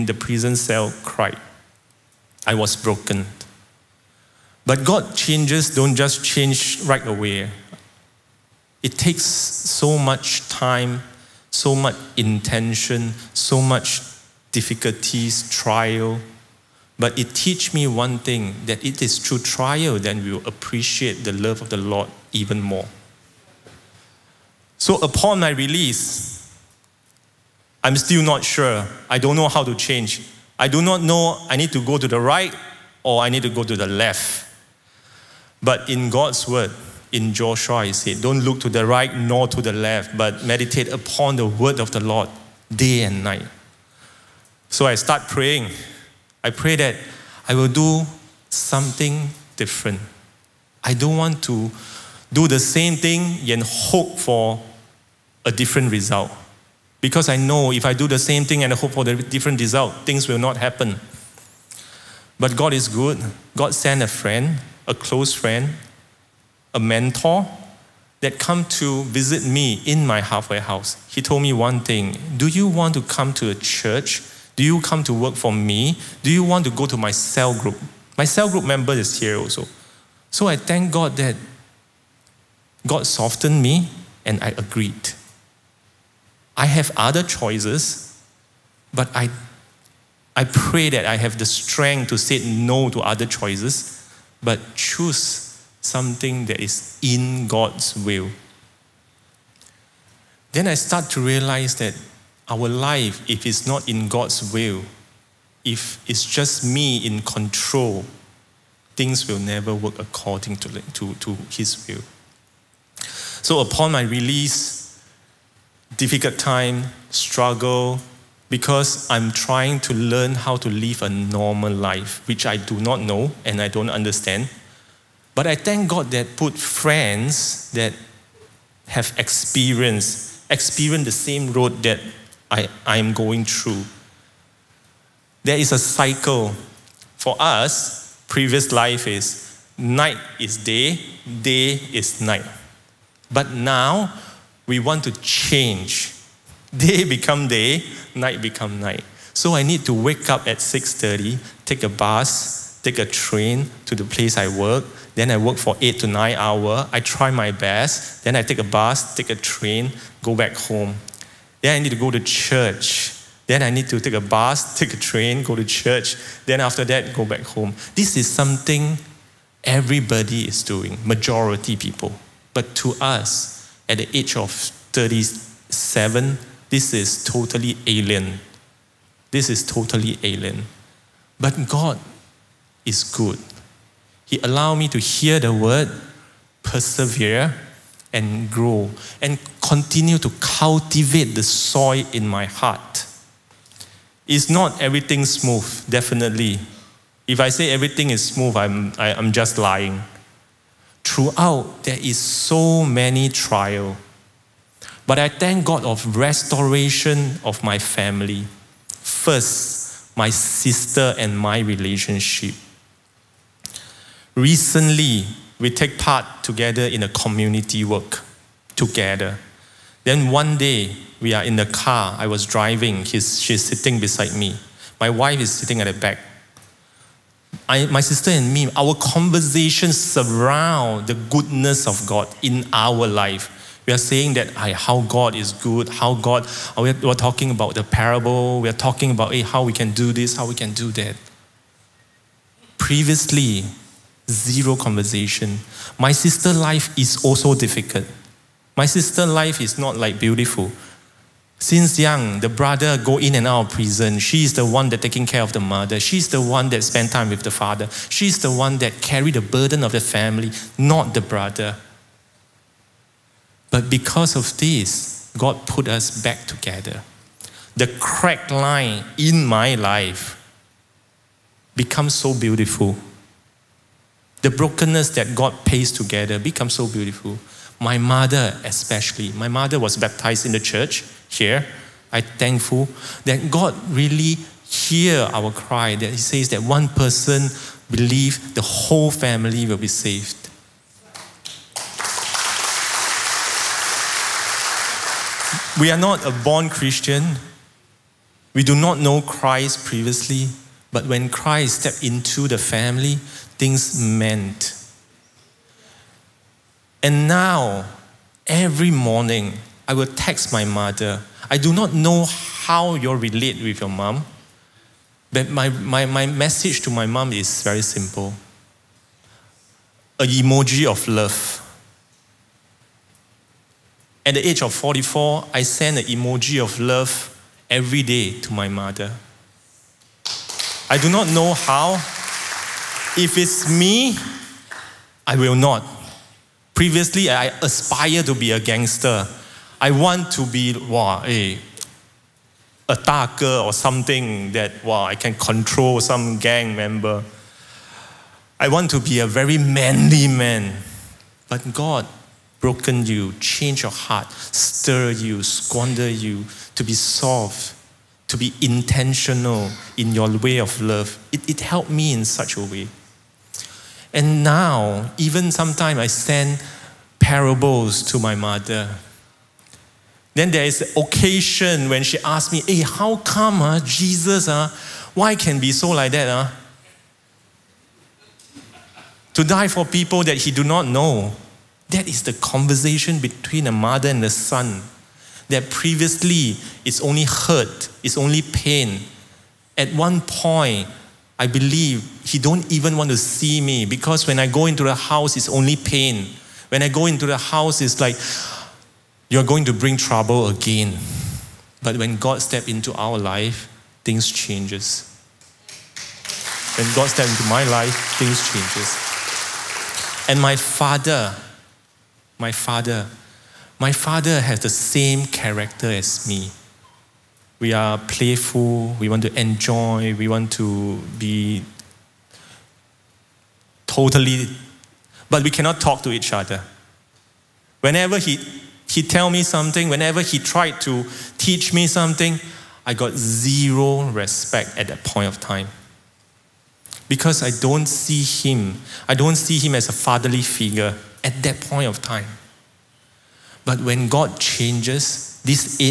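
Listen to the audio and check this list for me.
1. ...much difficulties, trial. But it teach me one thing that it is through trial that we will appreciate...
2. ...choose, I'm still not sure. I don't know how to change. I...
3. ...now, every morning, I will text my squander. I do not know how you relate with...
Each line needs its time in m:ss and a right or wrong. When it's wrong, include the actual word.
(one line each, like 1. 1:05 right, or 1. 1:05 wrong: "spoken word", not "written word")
1. 0:13 right
2. 0:25 wrong: "release", not "choose"
3. 5:07 wrong: "mother", not "squander".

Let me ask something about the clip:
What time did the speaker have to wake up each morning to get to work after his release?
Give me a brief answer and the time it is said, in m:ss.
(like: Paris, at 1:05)
6:30, at 2:30.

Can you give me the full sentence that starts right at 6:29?
At one point, I believe he don't even want to see me because when I go into the house, it's only pain.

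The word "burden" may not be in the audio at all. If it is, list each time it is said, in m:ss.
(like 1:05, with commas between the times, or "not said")
4:19.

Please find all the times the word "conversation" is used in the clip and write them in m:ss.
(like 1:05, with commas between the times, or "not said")
3:48, 4:04, 6:22.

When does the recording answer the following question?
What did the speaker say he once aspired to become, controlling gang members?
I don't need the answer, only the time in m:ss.
5:38.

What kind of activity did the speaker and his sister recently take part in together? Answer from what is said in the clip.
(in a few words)
community work.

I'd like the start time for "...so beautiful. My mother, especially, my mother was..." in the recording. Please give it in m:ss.
4:36.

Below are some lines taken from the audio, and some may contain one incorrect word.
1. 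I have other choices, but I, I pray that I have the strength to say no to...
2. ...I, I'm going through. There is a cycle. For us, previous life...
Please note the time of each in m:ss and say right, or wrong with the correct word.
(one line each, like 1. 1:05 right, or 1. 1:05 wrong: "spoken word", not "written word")
1. 1:26 right
2. 2:12 right.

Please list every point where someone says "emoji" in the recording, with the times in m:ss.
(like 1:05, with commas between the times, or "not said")
5:20, 5:26.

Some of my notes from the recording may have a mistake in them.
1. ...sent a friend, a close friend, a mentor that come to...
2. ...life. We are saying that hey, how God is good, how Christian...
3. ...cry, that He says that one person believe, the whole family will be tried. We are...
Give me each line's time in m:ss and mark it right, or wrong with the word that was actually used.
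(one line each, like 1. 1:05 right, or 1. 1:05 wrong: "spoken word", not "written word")
1. 1:03 right
2. 3:53 wrong: "God", not "Christian"
3. 4:45 wrong: "saved", not "tried".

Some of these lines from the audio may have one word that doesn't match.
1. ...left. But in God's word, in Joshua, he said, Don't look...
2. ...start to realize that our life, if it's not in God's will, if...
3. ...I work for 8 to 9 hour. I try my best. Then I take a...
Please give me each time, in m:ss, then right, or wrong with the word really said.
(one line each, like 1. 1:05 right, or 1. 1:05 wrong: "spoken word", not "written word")
1. 0:33 right
2. 1:40 right
3. 2:35 right.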